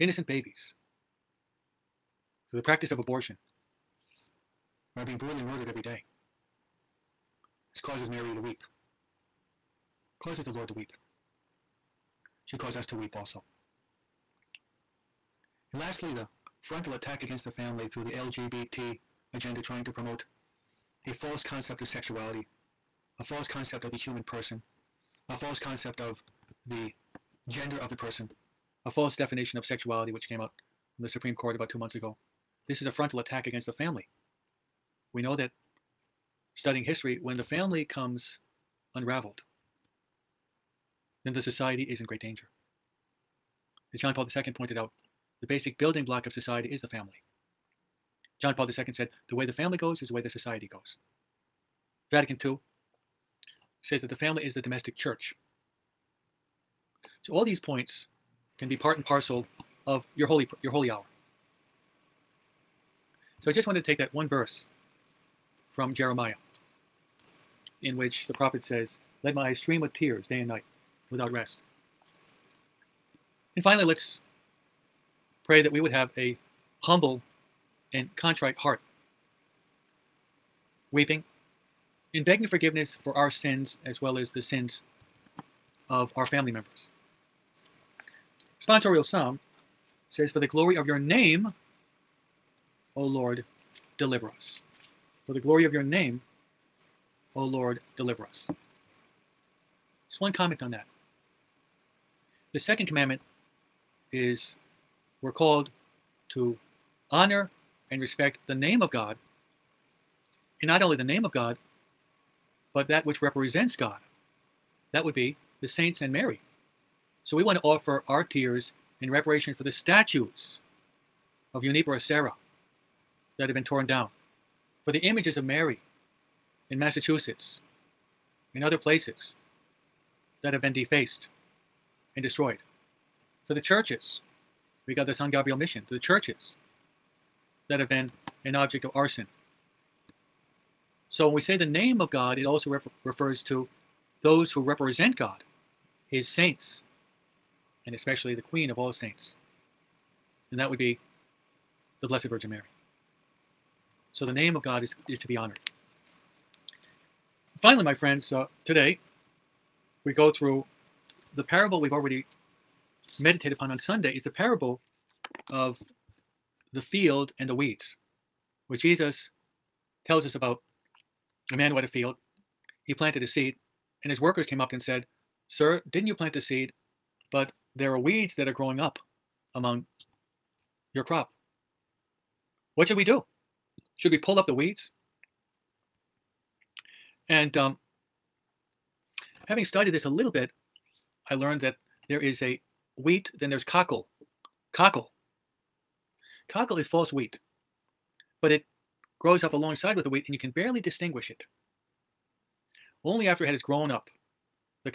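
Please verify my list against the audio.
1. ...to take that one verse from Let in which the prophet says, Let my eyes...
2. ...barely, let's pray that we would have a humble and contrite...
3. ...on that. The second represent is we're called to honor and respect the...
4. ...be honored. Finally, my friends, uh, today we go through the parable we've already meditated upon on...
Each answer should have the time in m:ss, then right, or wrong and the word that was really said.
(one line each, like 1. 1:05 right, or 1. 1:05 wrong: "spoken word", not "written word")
1. 1:03 wrong: "Jeremiah", not "Let"
2. 1:13 wrong: "finally", not "barely"
3. 1:40 wrong: "commandment", not "represent"
4. 2:35 right.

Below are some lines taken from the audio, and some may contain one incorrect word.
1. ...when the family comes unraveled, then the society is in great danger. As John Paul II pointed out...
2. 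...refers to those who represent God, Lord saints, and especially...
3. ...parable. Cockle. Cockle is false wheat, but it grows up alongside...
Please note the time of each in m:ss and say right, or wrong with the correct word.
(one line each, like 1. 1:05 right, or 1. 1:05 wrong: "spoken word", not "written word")
1. 0:37 right
2. 2:23 wrong: "His", not "Lord"
3. 3:13 wrong: "cockle", not "parable".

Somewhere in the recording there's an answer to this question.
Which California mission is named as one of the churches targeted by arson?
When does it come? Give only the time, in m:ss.
2:15.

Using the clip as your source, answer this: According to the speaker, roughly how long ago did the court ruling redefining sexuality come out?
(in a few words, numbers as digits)
about two months ago.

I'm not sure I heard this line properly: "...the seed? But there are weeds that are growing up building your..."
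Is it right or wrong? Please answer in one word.
wrong.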